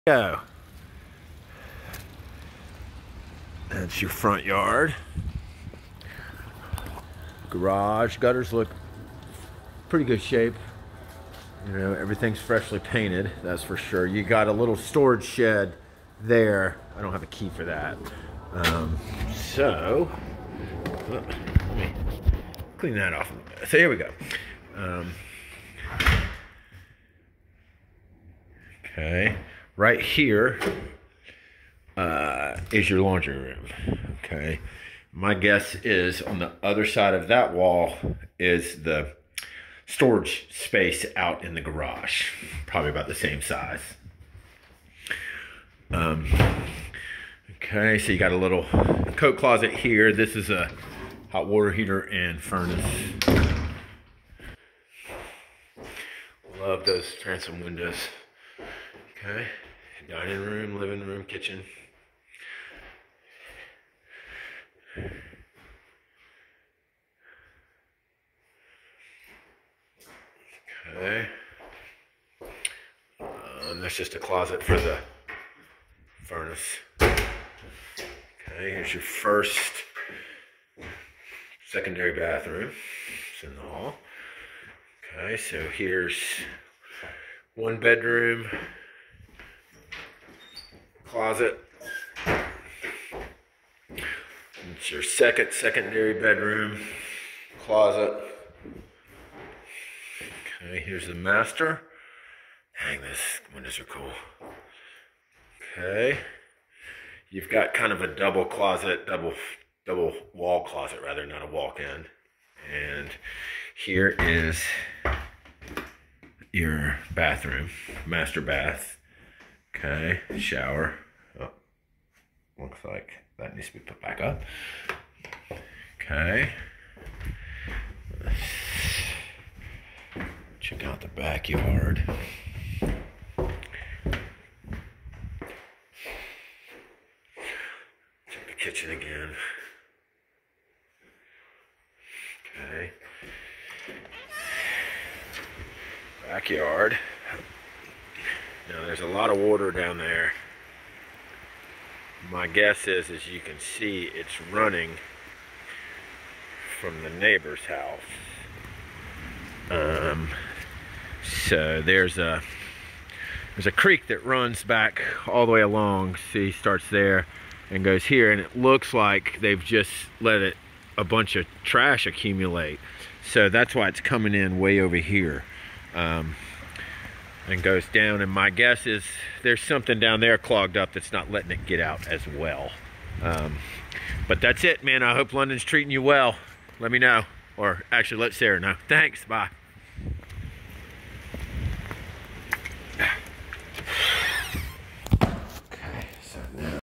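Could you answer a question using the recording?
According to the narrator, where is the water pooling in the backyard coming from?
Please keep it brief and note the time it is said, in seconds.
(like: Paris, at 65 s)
The neighbor's house, at 157 s.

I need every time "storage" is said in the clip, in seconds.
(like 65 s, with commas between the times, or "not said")
14 s, 39 s.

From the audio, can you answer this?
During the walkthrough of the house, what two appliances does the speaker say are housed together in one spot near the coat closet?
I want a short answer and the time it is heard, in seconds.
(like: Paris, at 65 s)
Hot water heater and furnace, at 51 s.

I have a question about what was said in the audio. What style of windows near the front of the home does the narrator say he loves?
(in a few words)
Transom windows.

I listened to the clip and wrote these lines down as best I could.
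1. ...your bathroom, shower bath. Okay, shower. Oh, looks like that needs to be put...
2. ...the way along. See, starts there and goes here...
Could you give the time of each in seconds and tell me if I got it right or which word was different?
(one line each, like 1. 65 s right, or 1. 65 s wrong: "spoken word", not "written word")
1. 116 s wrong: "master", not "shower"
2. 165 s right.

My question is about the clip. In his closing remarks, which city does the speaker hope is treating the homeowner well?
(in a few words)
London.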